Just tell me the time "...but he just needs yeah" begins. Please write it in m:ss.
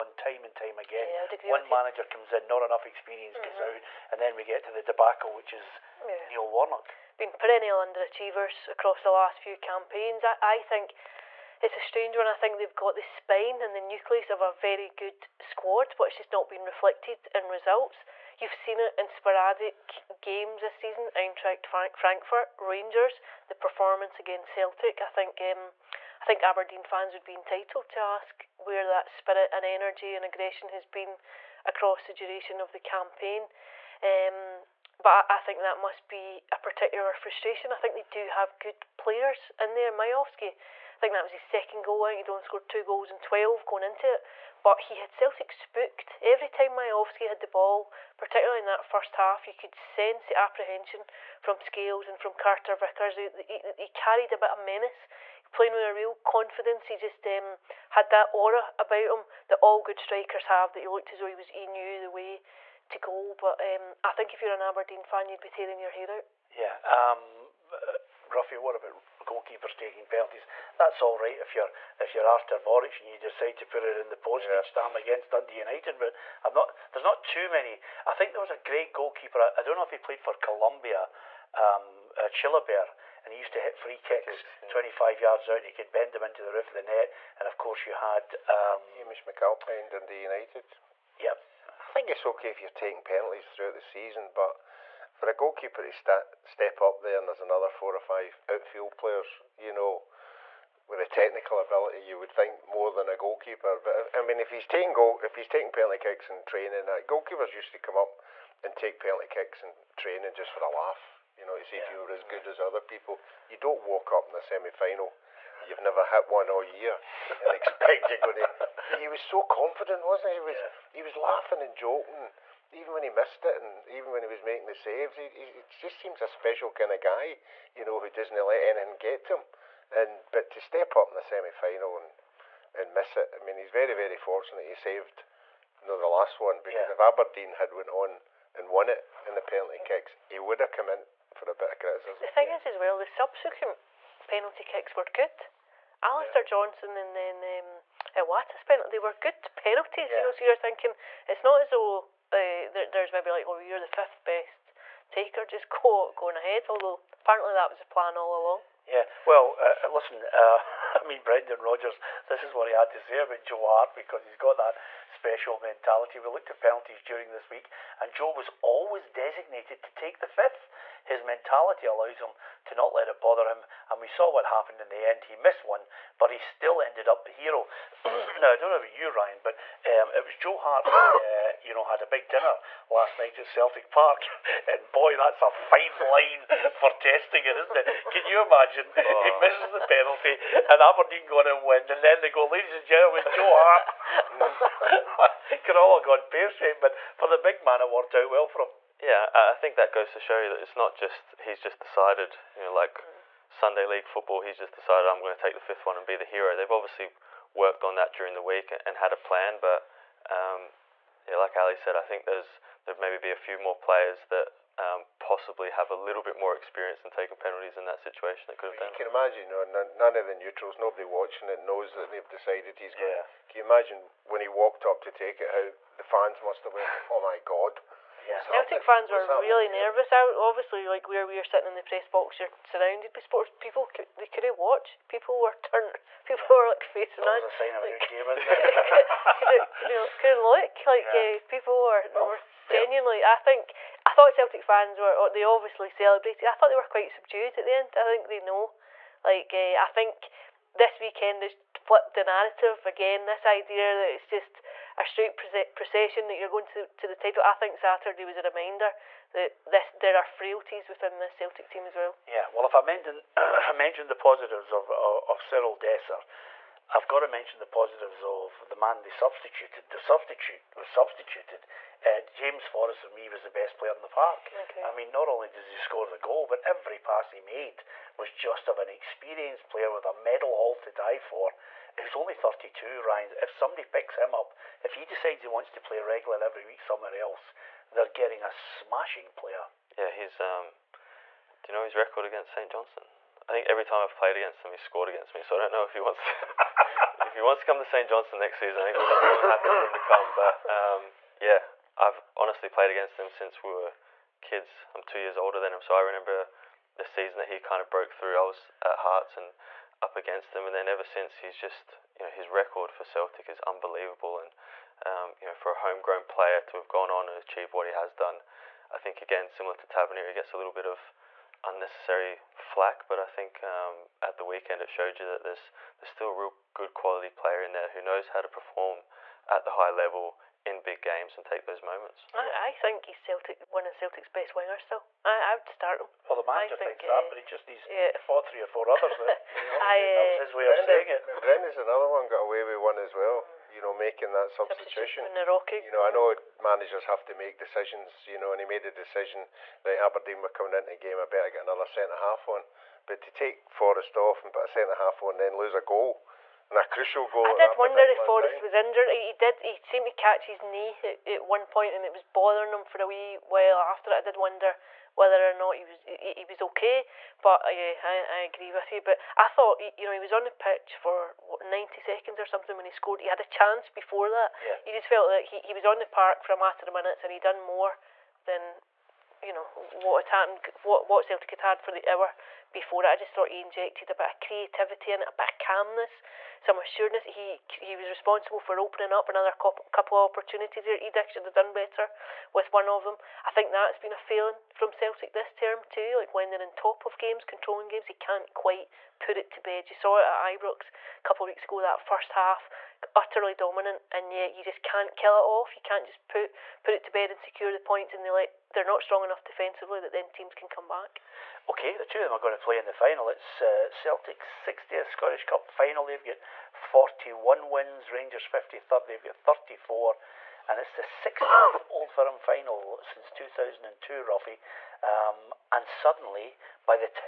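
5:37.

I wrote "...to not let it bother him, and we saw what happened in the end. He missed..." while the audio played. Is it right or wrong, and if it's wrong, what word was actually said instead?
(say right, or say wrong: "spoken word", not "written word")
right.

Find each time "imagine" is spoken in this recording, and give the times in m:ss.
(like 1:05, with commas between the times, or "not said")
3:08, 3:39, 3:43.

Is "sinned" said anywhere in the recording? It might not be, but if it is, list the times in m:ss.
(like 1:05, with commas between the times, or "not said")
not said.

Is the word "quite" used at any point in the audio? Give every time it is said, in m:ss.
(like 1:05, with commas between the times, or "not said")
4:06, 6:38.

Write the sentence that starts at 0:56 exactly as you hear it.
He just um, had that aura about him that all good strikers have.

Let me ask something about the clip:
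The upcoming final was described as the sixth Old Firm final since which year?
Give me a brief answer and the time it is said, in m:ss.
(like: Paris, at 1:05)
2002, at 7:03.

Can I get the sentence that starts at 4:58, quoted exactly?
I think we're happy for him to come.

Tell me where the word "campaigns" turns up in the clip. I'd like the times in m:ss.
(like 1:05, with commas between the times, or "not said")
0:09, 0:32.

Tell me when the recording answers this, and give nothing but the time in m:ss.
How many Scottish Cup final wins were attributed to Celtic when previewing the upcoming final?
6:56.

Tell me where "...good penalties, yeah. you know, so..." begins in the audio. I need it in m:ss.
2:29.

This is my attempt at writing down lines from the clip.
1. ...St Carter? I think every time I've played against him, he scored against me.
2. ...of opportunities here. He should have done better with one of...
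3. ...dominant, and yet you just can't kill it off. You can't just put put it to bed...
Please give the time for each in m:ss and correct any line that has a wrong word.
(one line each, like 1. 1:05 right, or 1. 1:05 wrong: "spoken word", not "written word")
1. 4:52 wrong: "Johnstone", not "Carter"
2. 6:29 right
3. 6:43 right.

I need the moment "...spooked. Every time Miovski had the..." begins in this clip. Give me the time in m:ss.
0:45.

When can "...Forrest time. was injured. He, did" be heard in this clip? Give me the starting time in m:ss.
5:58.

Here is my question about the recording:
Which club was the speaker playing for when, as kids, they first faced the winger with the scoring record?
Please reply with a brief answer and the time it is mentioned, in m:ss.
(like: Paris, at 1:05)
Hearts, at 5:08.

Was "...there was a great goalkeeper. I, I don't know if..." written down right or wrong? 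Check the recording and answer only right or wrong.
right.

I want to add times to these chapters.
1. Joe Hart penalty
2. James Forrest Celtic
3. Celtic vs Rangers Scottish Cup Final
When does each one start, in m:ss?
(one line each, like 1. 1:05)
1. 1:06
2. 4:22
3. 6:34.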